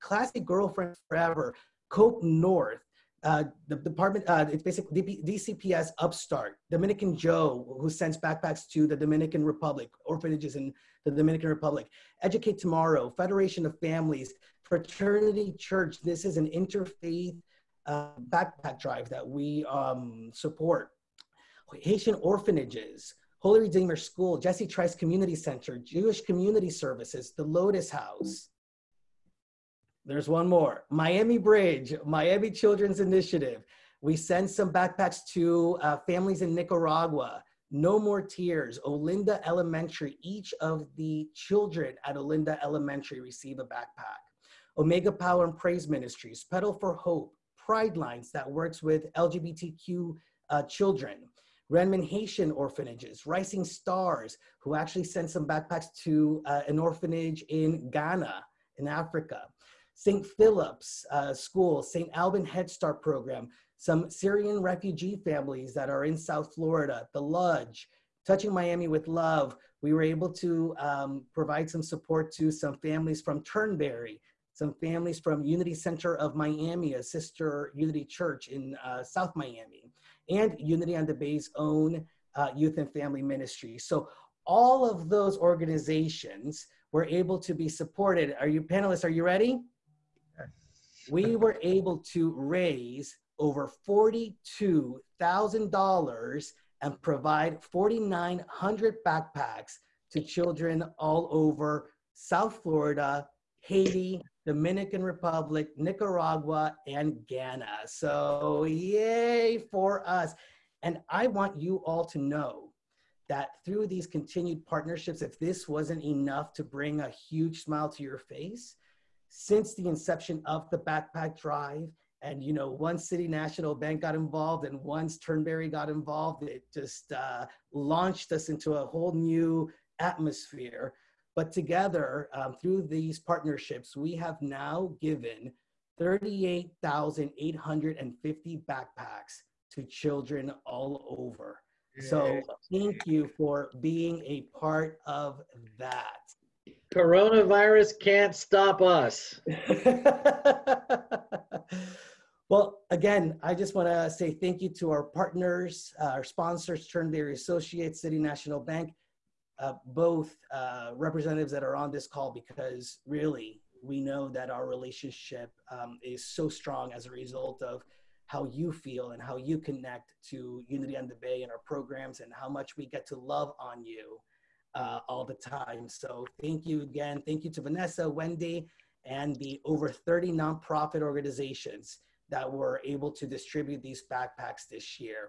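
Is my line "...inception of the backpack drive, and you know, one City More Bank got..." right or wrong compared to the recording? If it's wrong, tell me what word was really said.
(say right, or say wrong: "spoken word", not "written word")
wrong: "National", not "More".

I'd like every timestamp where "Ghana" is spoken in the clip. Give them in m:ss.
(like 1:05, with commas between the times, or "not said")
0:57, 1:47.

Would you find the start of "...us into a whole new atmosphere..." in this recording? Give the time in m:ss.
2:08.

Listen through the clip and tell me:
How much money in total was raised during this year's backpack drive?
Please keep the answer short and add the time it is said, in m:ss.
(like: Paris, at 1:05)
$42,000, at 1:33.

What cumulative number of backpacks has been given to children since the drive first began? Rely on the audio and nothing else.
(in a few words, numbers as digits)
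38,850.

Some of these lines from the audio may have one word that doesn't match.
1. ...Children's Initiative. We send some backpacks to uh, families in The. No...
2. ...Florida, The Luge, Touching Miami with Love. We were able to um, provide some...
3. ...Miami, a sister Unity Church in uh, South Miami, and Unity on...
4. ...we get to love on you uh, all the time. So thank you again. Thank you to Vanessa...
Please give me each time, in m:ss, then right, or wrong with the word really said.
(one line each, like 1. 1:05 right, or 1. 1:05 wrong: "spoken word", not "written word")
1. 0:32 wrong: "Nicaragua", not "The"
2. 1:06 right
3. 1:16 right
4. 2:52 right.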